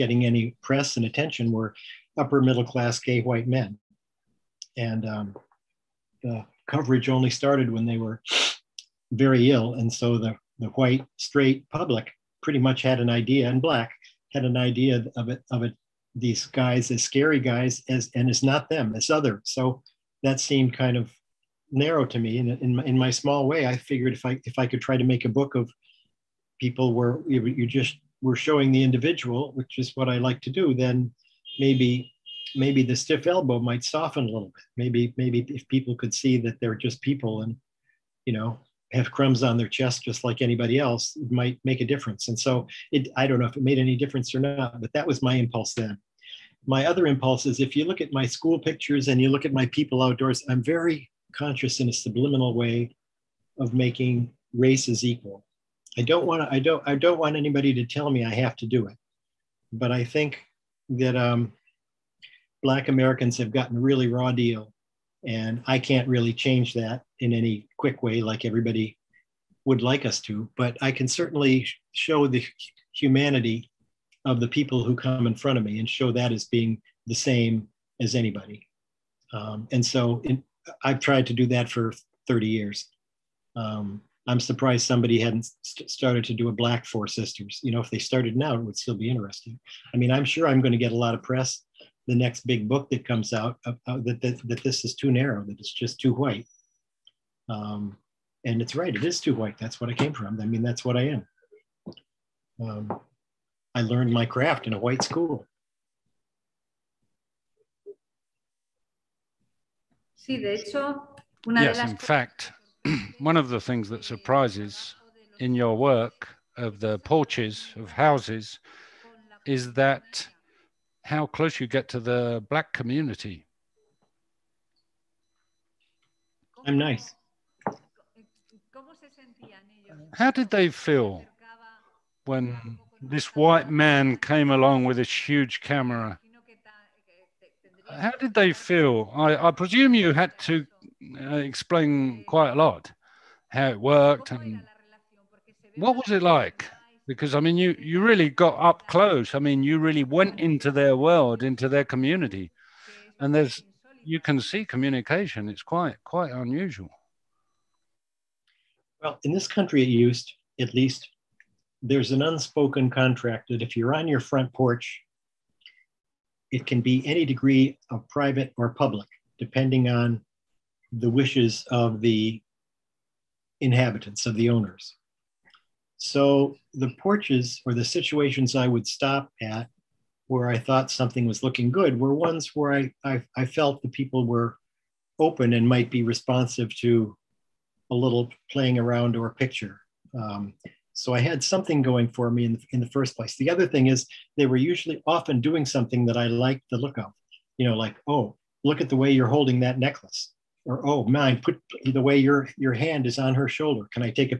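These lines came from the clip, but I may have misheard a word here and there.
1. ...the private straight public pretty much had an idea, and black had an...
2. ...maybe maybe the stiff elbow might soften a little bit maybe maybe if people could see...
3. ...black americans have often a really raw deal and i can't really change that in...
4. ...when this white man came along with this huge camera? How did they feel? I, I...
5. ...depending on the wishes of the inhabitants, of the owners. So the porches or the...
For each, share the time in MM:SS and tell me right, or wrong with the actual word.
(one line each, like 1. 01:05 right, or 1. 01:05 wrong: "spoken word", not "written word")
1. 00:10 wrong: "white", not "private"
2. 00:31 right
3. 01:02 wrong: "gotten", not "often"
4. 02:12 right
5. 02:49 right.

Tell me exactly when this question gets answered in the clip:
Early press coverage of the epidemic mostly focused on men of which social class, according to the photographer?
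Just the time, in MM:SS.
00:02.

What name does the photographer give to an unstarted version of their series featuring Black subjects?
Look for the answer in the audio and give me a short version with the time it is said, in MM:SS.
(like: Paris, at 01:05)
Black Four Sisters, at 01:26.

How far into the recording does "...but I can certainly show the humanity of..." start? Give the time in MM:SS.
01:10.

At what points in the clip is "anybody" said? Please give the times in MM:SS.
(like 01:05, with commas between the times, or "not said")
00:40, 00:57, 01:18.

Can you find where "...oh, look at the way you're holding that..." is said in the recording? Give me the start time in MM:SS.
03:18.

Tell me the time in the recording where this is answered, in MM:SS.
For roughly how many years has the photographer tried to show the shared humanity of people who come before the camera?
01:22.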